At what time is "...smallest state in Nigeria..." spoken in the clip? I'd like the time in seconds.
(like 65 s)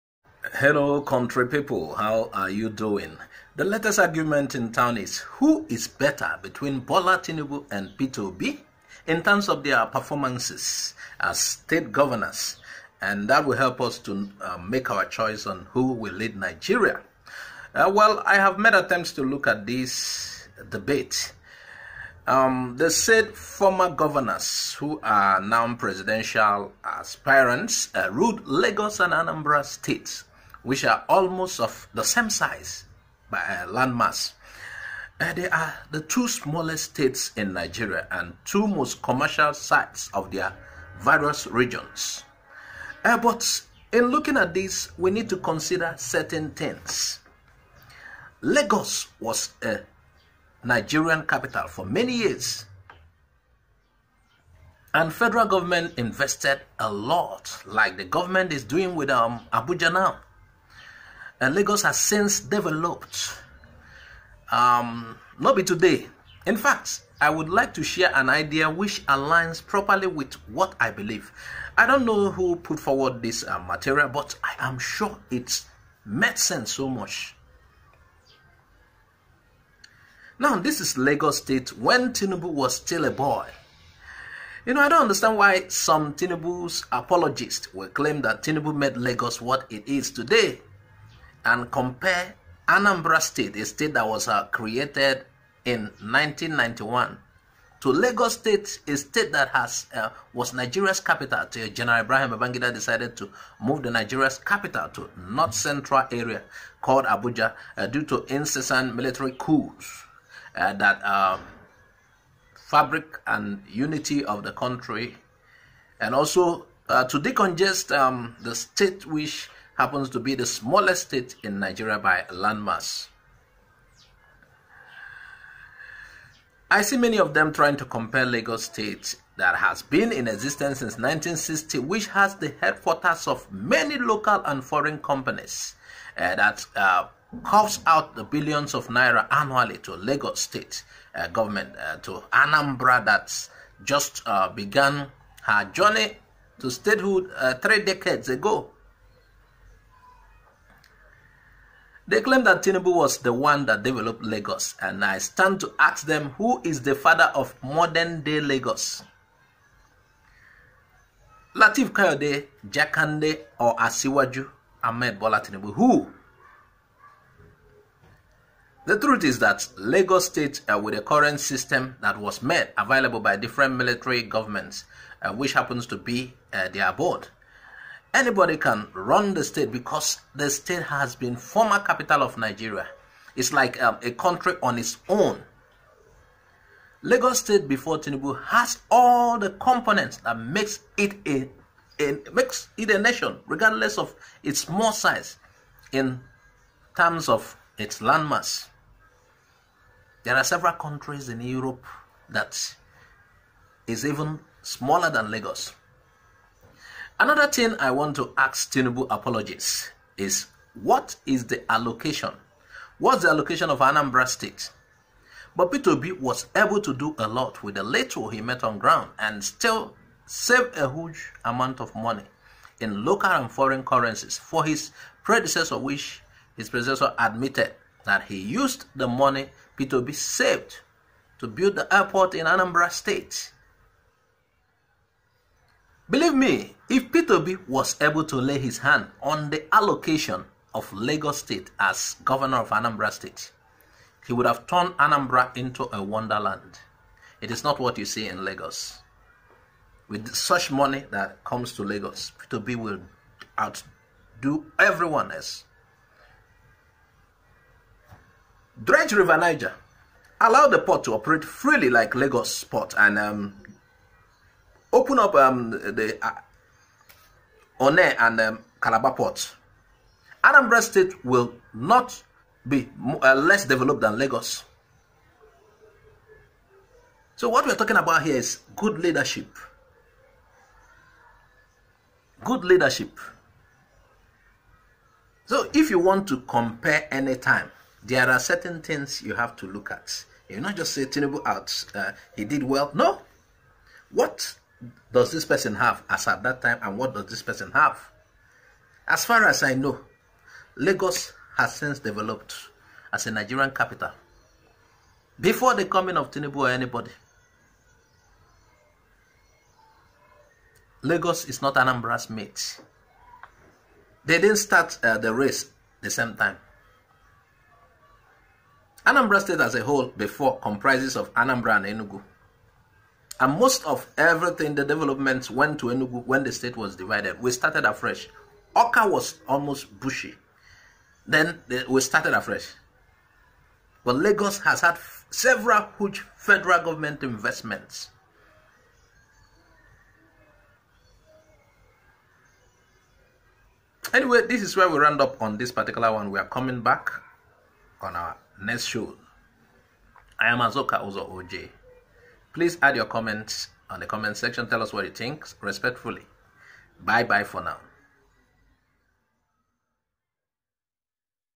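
120 s.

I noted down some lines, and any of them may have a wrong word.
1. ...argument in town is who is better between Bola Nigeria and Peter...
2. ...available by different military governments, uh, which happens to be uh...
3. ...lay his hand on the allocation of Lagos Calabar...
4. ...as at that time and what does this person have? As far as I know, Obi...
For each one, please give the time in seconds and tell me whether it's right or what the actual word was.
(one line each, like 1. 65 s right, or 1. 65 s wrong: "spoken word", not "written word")
1. 3 s wrong: "Tinubu", not "Nigeria"
2. 172 s right
3. 238 s wrong: "State", not "Calabar"
4. 296 s wrong: "Lagos", not "Obi".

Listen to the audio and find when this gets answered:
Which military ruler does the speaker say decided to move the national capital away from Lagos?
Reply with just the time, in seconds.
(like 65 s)
102 s.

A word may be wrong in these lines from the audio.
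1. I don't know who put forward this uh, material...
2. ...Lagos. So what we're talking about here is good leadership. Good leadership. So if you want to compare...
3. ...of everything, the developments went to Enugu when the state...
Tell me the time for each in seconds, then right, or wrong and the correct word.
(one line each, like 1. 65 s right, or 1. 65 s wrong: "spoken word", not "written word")
1. 71 s right
2. 274 s right
3. 323 s right.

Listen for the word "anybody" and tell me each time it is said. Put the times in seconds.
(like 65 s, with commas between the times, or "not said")
178 s, 306 s.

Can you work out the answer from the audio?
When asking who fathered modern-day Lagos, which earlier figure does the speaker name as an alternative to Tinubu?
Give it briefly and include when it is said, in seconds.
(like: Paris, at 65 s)
Lateef Kayode Jakande, at 161 s.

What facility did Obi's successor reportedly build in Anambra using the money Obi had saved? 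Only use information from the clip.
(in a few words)
The airport.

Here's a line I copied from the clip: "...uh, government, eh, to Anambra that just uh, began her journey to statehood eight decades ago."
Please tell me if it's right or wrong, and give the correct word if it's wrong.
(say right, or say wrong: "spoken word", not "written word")
wrong: "three", not "eight".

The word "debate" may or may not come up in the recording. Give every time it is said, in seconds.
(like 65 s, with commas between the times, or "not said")
20 s.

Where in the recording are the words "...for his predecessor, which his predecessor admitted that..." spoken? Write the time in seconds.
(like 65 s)
224 s.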